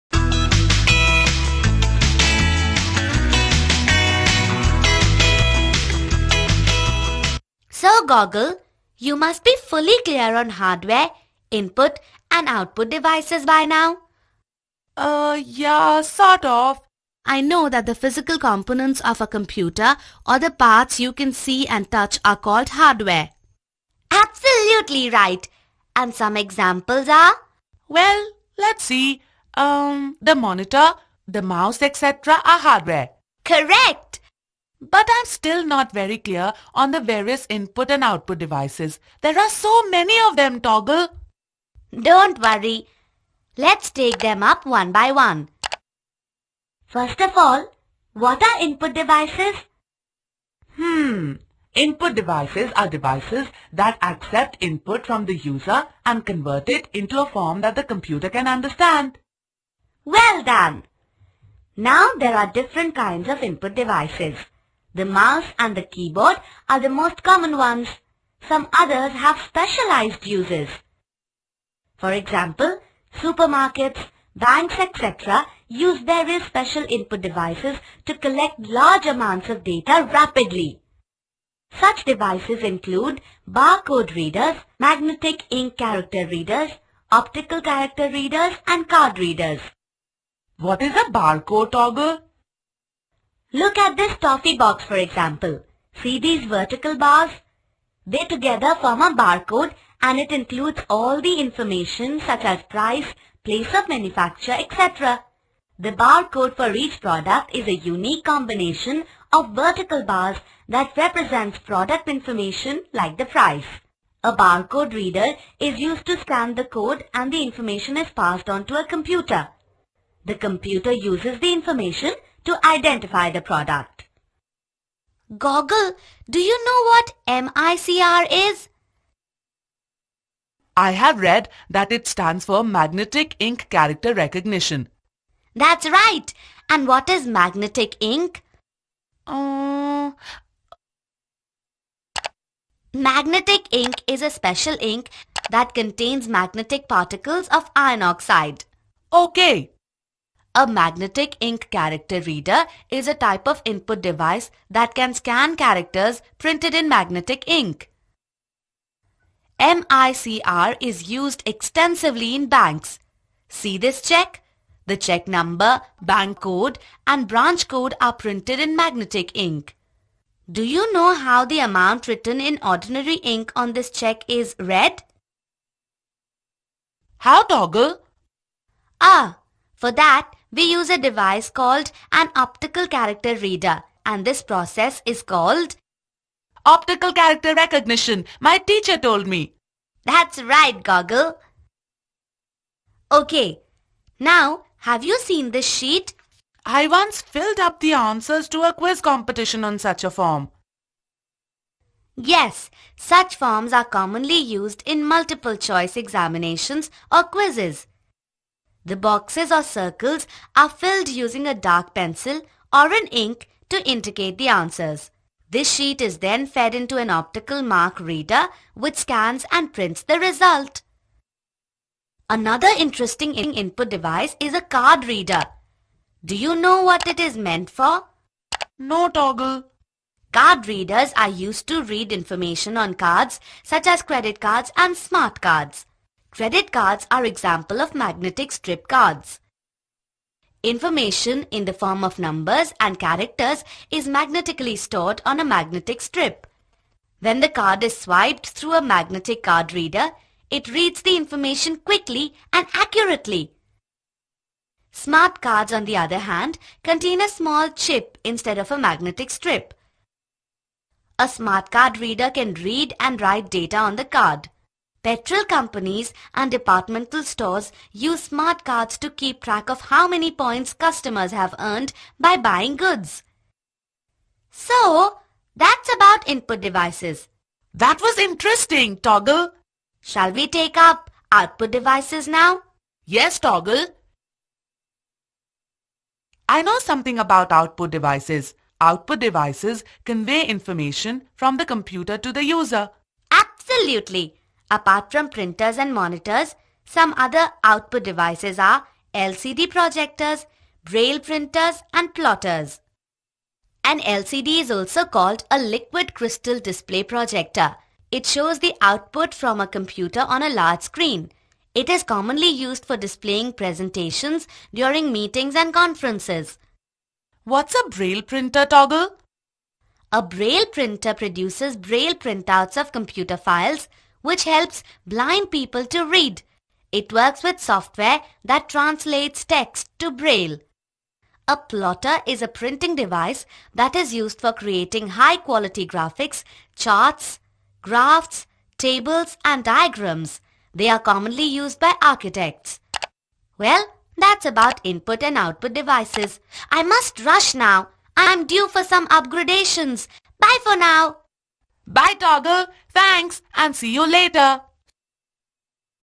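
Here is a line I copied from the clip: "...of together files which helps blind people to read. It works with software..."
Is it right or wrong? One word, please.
wrong.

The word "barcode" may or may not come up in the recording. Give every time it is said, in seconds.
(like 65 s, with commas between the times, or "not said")
83 s, 91 s, 99 s, 105 s, 114 s.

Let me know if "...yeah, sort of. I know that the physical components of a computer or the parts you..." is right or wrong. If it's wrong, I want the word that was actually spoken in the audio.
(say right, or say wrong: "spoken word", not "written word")
right.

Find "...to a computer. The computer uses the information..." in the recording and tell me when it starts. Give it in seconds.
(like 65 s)
118 s.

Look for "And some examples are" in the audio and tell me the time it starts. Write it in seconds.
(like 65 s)
25 s.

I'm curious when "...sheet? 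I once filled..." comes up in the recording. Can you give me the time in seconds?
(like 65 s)
195 s.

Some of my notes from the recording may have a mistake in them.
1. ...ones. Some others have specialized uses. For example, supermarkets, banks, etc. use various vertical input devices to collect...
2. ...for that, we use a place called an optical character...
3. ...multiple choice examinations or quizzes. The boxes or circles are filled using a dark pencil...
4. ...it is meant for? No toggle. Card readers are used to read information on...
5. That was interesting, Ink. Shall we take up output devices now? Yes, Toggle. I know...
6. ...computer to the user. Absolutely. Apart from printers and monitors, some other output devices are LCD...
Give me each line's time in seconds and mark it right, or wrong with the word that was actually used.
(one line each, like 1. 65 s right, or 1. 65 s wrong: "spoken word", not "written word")
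1. 67 s wrong: "special", not "vertical"
2. 179 s wrong: "device", not "place"
3. 205 s right
4. 227 s right
5. 277 s wrong: "Toggle", not "Ink"
6. 291 s right.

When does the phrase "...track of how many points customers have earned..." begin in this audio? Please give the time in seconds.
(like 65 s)
269 s.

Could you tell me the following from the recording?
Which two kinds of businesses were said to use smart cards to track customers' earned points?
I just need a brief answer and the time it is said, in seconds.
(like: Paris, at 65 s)
Petrol companies and departmental stores, at 265 s.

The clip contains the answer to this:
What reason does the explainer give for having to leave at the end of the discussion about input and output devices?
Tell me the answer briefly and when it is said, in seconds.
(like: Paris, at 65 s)
upgradations, at 349 s.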